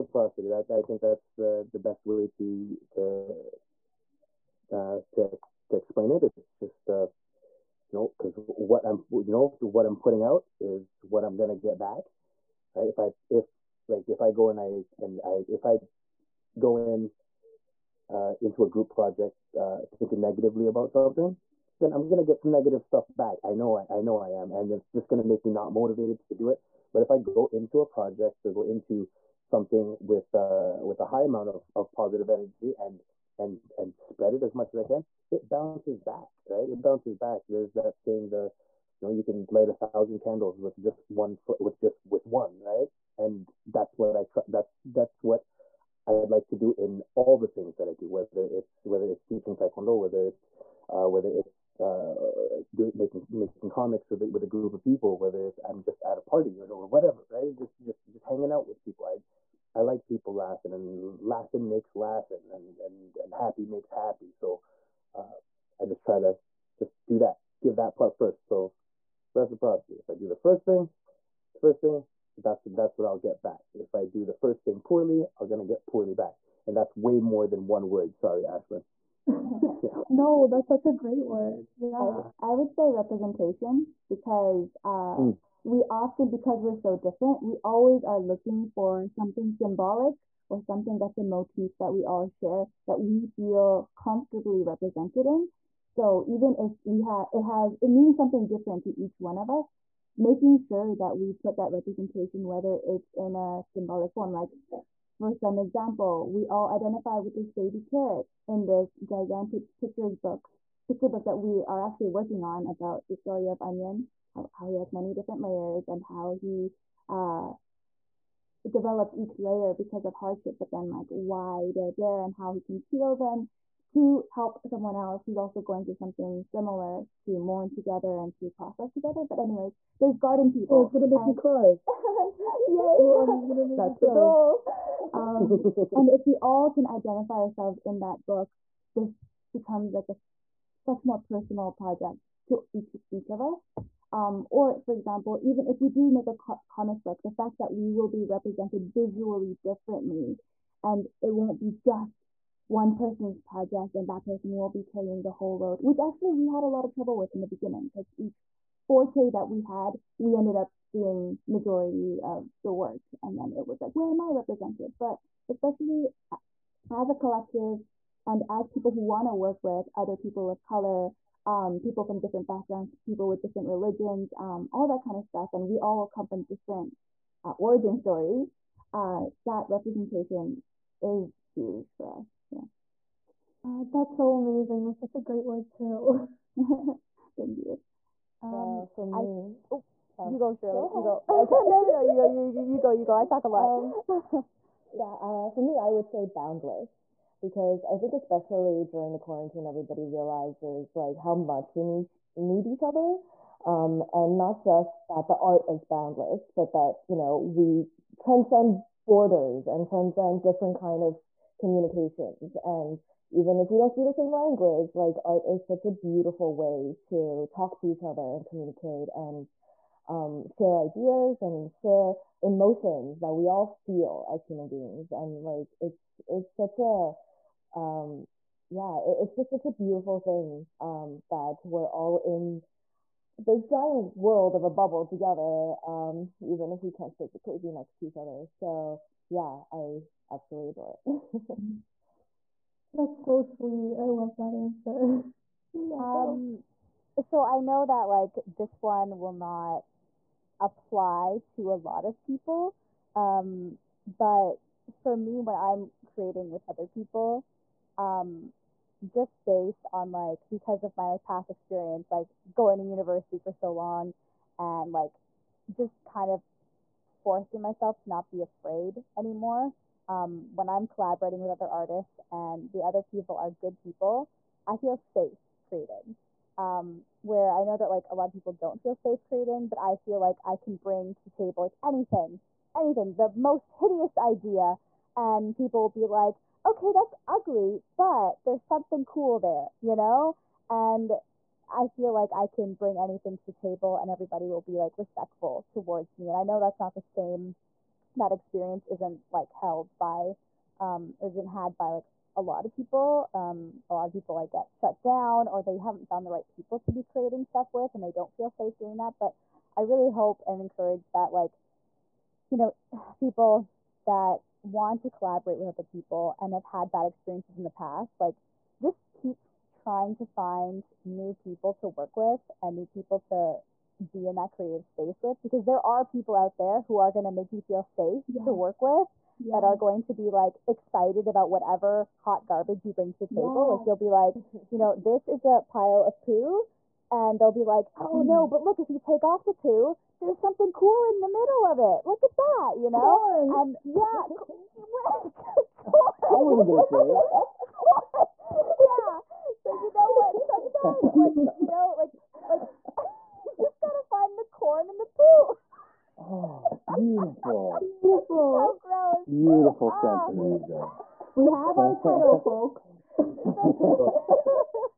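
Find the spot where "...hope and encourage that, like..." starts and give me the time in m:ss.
5:10.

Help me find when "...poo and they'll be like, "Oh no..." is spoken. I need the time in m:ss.
5:36.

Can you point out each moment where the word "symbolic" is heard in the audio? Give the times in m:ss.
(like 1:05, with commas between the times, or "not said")
1:29, 1:43.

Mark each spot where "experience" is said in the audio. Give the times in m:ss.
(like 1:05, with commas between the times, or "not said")
4:21, 4:58, 5:17.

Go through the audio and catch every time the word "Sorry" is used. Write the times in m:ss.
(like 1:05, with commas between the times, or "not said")
1:18.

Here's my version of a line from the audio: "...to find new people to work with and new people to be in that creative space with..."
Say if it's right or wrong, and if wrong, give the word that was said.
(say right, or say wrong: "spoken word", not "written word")
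right.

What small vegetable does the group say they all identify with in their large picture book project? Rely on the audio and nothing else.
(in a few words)
Baby carrot.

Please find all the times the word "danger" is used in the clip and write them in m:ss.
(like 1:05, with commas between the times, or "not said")
not said.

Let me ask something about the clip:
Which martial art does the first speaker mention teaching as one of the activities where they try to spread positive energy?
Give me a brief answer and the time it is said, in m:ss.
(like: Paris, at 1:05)
Taekwondo, at 0:49.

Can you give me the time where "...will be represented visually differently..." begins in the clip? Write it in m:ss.
2:27.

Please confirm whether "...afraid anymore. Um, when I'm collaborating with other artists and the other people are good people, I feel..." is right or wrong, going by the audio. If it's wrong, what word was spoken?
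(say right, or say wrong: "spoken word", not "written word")
right.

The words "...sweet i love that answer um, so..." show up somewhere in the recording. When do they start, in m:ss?
4:03.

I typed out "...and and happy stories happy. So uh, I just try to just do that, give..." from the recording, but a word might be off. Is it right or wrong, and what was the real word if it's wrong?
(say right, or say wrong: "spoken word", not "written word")
wrong: "makes", not "stories".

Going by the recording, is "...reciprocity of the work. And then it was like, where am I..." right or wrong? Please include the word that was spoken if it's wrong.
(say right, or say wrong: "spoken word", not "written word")
wrong: "majority", not "reciprocity".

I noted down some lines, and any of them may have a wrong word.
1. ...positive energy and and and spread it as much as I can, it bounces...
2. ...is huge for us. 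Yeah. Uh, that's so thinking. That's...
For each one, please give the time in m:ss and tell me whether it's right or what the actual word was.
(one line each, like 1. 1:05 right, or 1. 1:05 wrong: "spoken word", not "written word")
1. 0:31 right
2. 3:00 wrong: "amazing", not "thinking".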